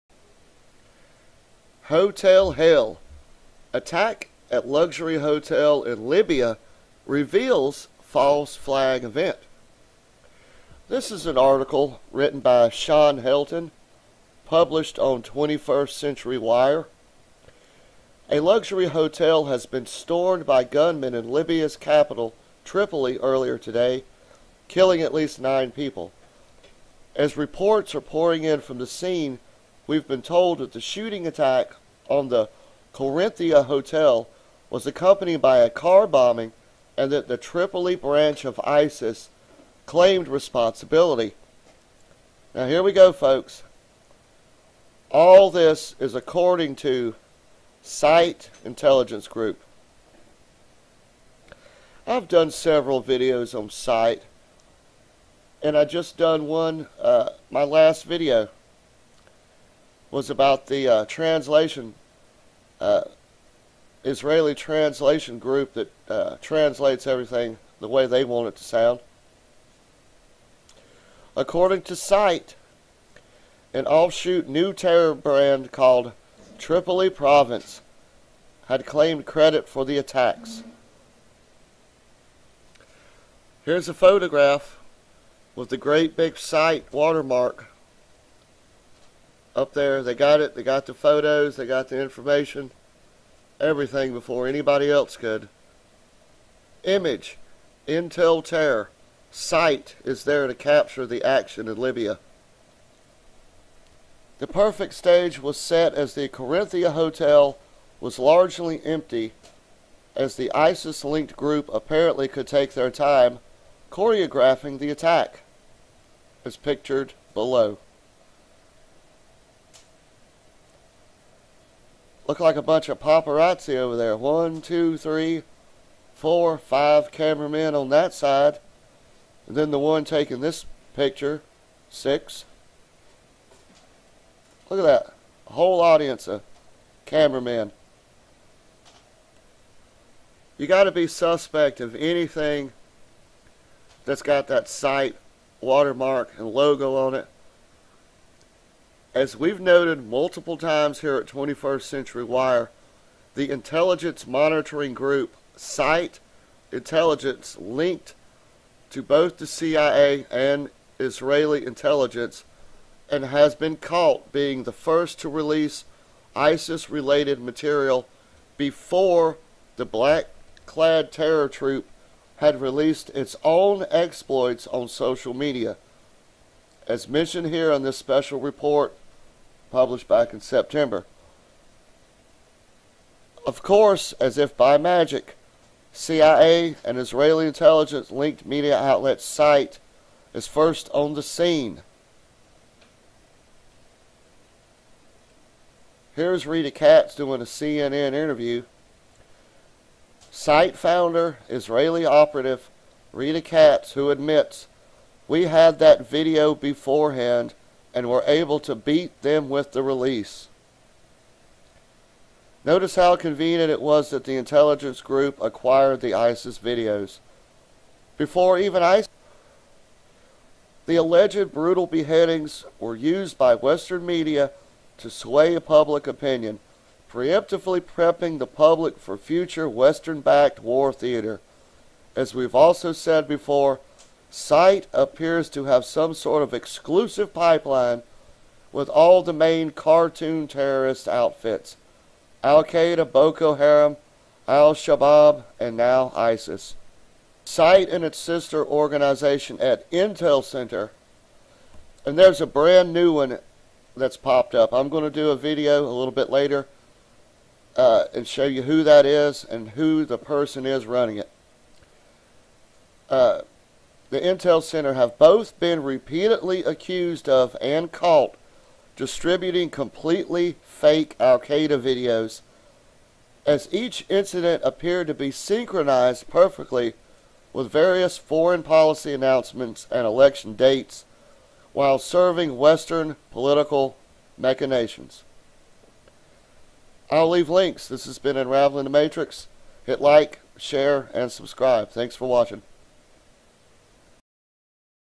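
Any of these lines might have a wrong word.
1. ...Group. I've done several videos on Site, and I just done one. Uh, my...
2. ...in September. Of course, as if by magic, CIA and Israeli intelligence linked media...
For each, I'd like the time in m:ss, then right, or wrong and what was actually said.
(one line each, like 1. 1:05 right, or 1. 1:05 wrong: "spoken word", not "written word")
1. 0:49 right
2. 3:00 right.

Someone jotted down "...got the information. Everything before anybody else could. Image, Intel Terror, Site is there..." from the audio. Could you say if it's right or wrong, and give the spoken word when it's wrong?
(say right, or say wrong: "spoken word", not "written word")
right.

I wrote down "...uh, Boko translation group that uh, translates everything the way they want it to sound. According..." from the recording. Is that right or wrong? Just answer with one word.
wrong.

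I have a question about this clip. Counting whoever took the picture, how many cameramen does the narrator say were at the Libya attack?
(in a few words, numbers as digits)
6.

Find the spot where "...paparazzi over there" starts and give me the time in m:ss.
2:02.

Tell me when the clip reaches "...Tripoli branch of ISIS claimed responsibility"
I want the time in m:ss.
0:37.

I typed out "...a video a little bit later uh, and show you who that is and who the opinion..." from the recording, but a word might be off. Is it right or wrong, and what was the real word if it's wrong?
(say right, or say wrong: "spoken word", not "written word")
wrong: "person", not "opinion".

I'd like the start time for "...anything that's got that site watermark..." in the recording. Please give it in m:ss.
2:21.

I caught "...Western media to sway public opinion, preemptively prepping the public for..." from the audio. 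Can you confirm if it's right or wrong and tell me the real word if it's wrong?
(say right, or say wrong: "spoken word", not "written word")
right.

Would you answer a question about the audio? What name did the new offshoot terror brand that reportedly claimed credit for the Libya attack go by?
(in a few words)
Tripoli Province.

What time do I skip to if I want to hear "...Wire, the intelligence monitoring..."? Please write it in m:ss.
2:32.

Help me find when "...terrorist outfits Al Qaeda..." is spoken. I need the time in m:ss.
4:00.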